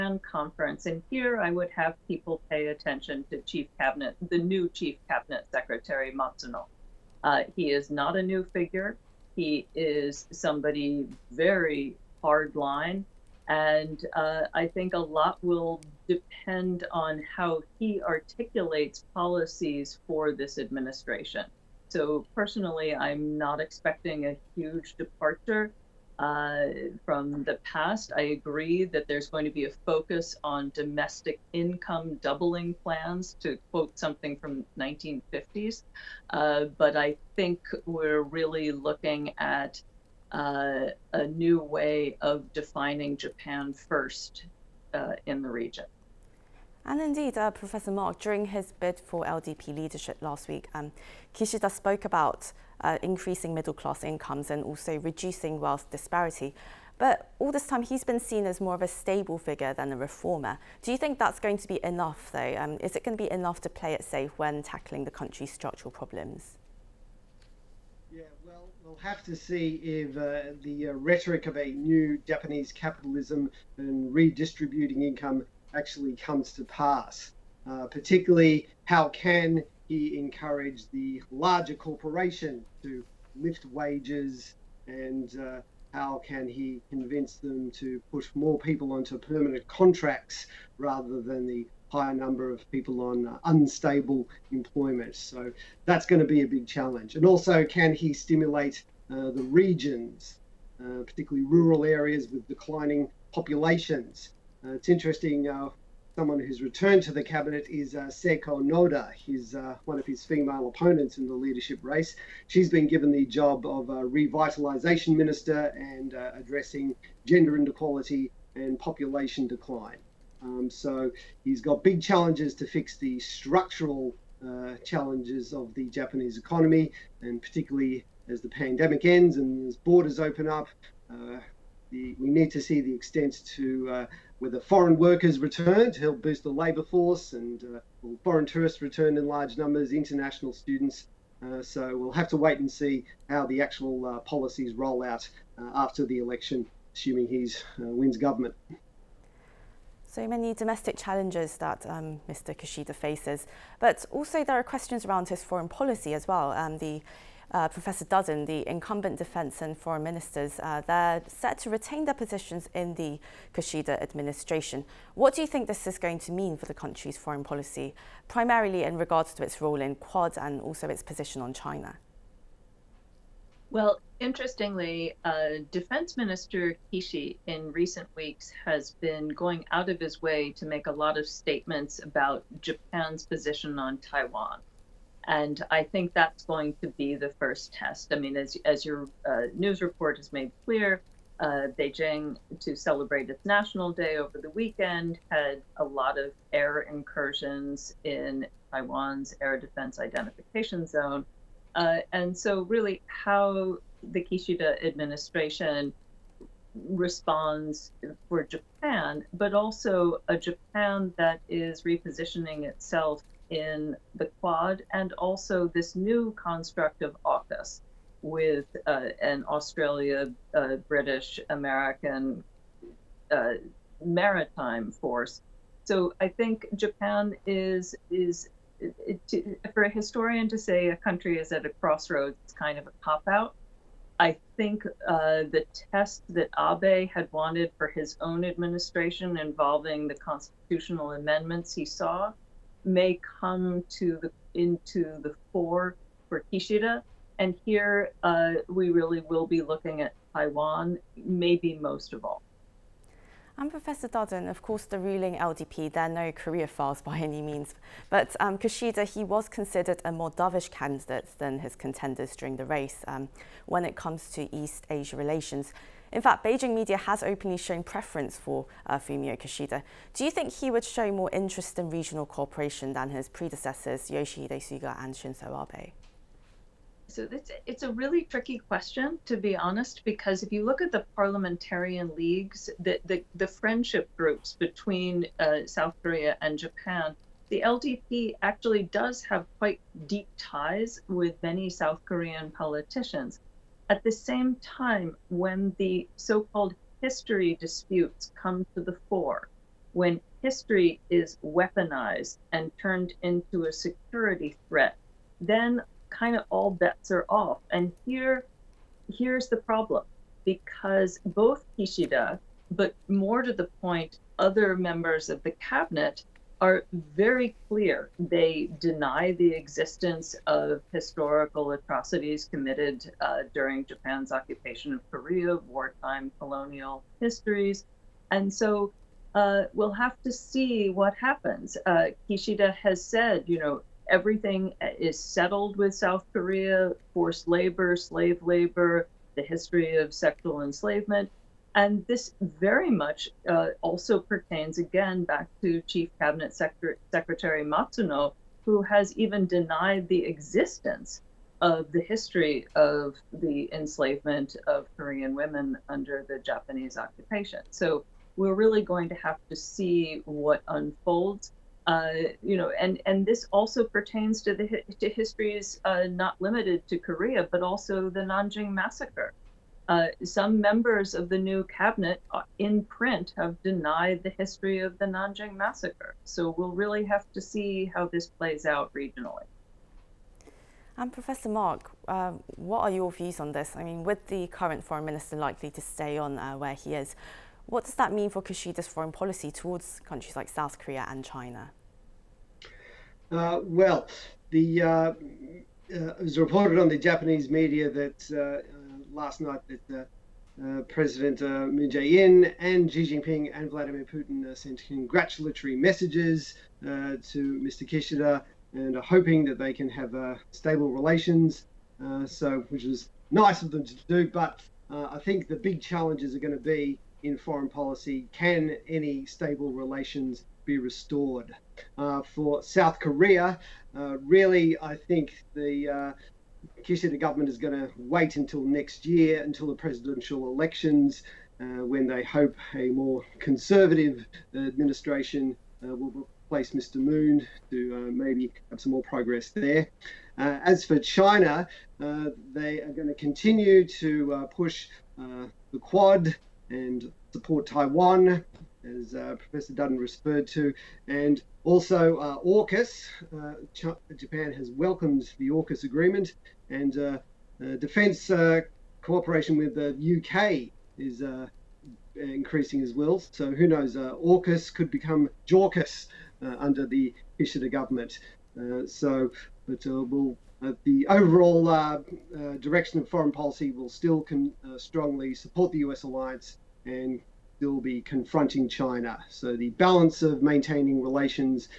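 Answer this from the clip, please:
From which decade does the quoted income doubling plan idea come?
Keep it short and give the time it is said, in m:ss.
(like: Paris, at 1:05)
1950s, at 0:34.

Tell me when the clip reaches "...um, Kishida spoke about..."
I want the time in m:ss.
0:50.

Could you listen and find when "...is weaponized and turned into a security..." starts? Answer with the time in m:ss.
5:01.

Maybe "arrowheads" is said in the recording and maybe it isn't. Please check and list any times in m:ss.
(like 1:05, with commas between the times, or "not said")
not said.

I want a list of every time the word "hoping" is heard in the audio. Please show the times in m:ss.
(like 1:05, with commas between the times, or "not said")
6:49.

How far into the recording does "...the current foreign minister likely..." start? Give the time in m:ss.
6:24.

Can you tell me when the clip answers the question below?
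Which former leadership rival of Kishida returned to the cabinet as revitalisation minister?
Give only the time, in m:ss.
1:48.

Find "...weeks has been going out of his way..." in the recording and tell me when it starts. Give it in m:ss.
2:58.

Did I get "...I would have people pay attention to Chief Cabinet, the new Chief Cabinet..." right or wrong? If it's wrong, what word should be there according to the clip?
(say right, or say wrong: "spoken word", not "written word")
right.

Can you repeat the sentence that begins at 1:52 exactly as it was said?
She's been given the job of revitalisation minister and uh, addressing gender inequality and population decline.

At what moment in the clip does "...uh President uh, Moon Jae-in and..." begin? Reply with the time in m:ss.
6:40.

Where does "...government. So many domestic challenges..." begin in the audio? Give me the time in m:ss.
2:28.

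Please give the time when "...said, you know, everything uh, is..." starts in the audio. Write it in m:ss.
5:33.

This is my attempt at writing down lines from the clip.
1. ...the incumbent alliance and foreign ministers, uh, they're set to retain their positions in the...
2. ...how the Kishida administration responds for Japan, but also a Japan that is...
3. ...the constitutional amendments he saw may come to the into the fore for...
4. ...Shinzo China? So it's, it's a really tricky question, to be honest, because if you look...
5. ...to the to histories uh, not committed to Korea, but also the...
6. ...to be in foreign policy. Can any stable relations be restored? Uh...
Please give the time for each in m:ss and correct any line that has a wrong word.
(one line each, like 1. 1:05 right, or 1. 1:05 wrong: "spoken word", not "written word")
1. 2:38 wrong: "defence", not "alliance"
2. 3:23 right
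3. 4:00 right
4. 4:35 wrong: "Abe", not "China"
5. 6:04 wrong: "limited", not "committed"
6. 6:56 right.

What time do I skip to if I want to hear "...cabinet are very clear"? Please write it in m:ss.
5:15.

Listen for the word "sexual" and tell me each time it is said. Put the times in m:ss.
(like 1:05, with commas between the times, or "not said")
5:40.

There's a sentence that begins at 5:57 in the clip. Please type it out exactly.
So we're really going to have to see what unfolds.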